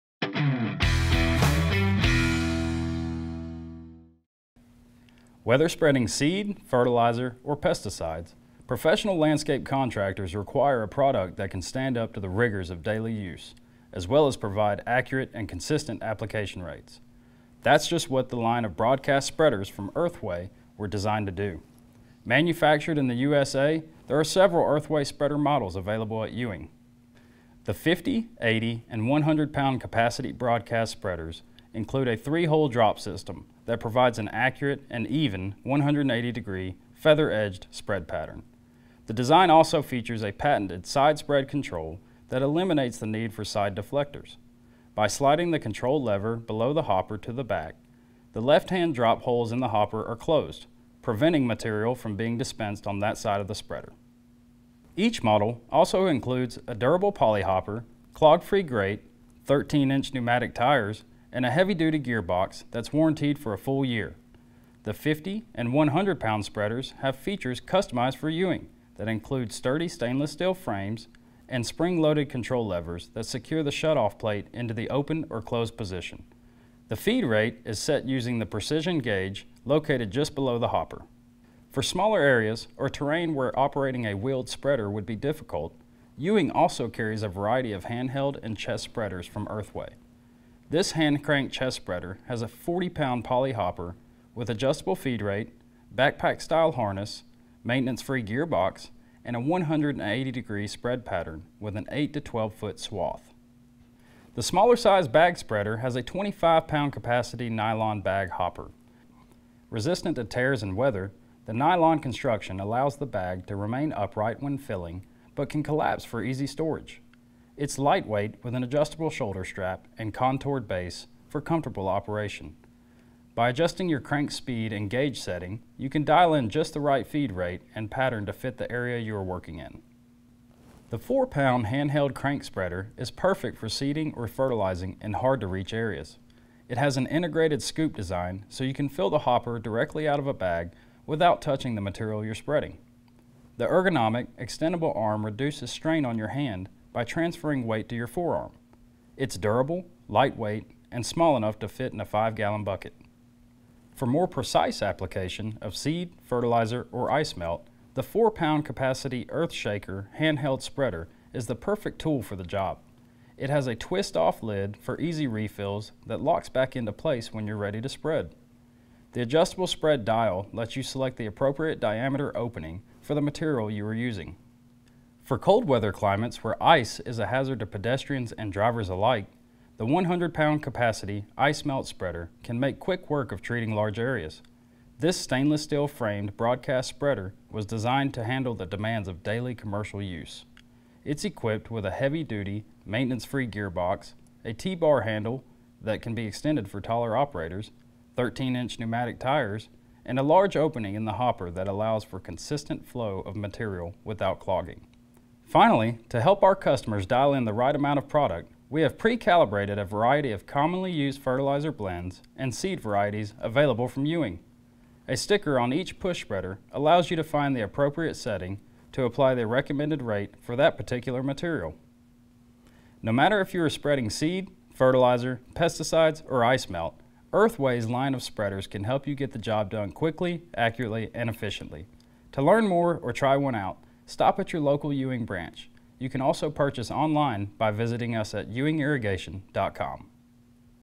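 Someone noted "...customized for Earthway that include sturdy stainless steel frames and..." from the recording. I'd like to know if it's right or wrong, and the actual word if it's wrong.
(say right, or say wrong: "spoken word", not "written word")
wrong: "Ewing", not "Earthway".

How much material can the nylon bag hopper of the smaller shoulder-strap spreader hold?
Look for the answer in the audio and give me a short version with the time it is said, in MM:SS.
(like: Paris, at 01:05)
25 pounds, at 01:46.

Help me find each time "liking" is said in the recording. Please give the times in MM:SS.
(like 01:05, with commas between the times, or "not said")
not said.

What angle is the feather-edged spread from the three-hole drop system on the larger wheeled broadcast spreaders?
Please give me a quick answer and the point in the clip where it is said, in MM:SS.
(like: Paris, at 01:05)
180-degree, at 00:35.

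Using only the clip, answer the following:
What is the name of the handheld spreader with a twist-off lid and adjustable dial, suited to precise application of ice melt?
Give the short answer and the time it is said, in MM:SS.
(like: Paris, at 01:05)
Earth Shaker, at 02:39.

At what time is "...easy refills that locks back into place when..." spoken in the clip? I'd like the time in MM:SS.
02:44.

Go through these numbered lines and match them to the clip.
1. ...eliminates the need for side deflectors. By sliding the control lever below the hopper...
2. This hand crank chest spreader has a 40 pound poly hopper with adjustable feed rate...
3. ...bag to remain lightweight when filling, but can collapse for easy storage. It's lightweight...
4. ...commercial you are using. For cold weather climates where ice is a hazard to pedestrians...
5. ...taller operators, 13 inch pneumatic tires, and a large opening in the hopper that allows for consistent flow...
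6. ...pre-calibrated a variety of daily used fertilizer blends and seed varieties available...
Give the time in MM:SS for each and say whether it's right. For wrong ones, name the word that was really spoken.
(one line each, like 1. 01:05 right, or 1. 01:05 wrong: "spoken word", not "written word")
1. 00:42 right
2. 01:30 right
3. 01:53 wrong: "upright", not "lightweight"
4. 02:53 wrong: "material", not "commercial"
5. 03:16 right
6. 03:28 wrong: "commonly", not "daily".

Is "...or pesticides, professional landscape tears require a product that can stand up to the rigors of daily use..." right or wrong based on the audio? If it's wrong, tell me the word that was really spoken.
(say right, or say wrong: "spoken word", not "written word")
wrong: "contractors", not "tears".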